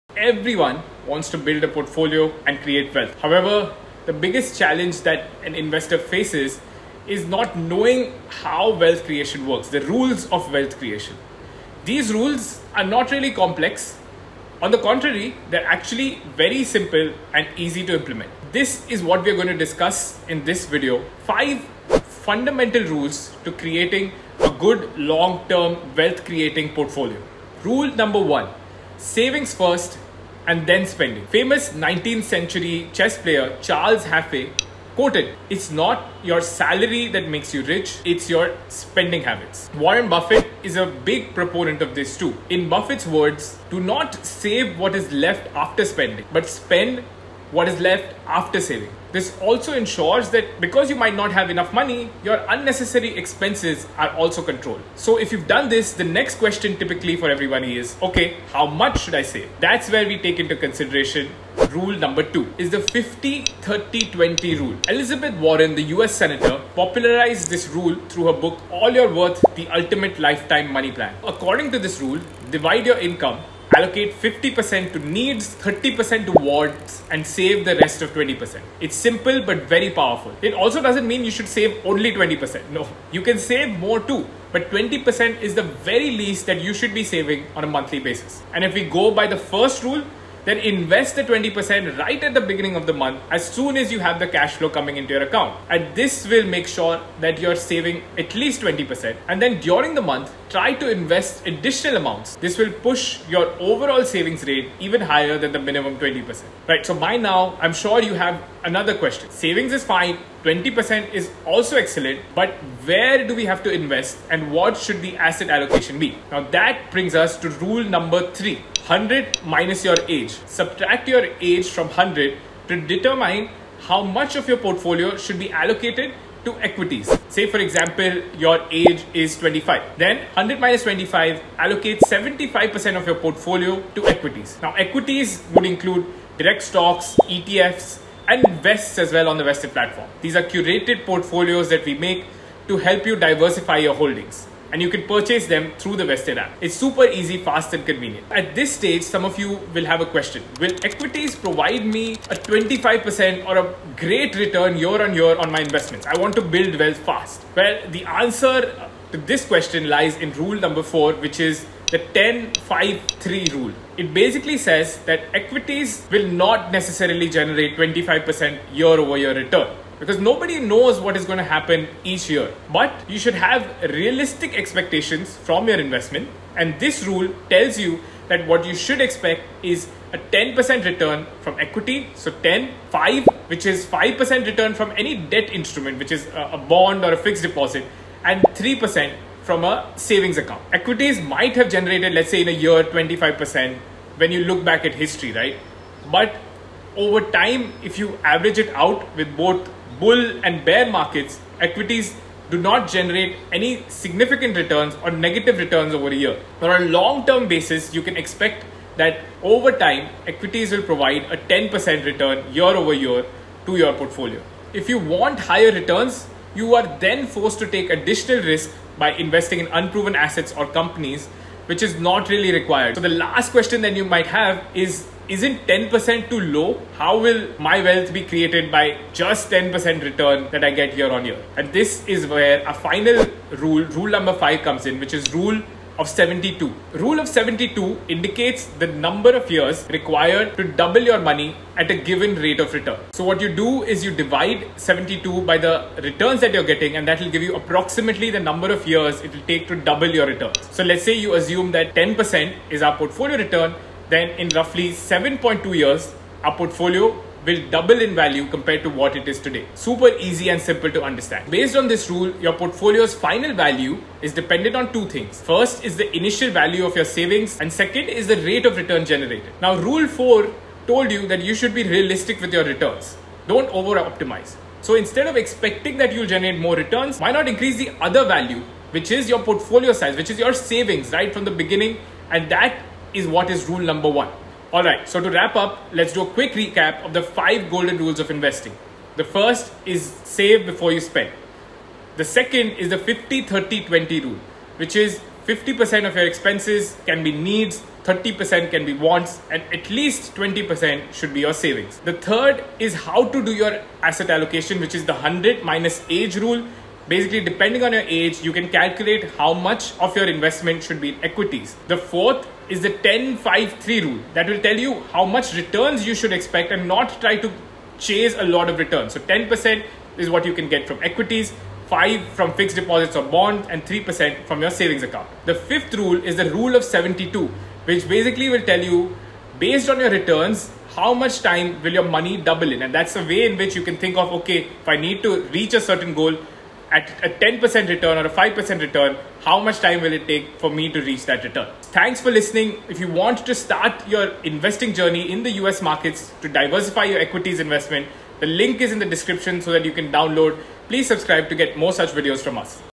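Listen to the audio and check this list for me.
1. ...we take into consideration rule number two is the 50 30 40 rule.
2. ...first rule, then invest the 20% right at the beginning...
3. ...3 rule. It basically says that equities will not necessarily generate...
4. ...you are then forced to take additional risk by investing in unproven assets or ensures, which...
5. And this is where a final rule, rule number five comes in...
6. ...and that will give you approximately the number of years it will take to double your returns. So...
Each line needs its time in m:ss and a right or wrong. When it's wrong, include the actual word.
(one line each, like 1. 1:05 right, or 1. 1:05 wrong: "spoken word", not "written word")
1. 1:00 wrong: "20", not "40"
2. 1:29 right
3. 2:43 right
4. 3:36 wrong: "companies", not "ensures"
5. 3:51 right
6. 4:06 right.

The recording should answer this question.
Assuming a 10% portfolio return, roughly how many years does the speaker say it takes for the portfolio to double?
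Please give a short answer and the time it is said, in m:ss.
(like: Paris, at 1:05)
7.2 years, at 4:14.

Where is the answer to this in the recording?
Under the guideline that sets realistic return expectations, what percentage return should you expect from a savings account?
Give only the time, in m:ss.
3:08.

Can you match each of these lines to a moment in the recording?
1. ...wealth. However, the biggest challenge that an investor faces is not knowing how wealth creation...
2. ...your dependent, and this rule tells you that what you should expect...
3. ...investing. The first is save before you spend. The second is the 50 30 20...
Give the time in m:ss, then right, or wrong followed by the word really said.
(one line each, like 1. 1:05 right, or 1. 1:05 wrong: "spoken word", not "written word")
1. 0:02 right
2. 2:55 wrong: "investment", not "dependent"
3. 4:48 right.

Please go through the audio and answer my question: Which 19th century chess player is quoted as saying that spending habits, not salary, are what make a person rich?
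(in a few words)
Charles Jaffe.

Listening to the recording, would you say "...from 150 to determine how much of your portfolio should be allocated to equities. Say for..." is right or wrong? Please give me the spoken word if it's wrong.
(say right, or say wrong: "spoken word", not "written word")
wrong: "100", not "150".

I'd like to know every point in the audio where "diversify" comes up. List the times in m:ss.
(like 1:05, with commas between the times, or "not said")
2:23, 5:46.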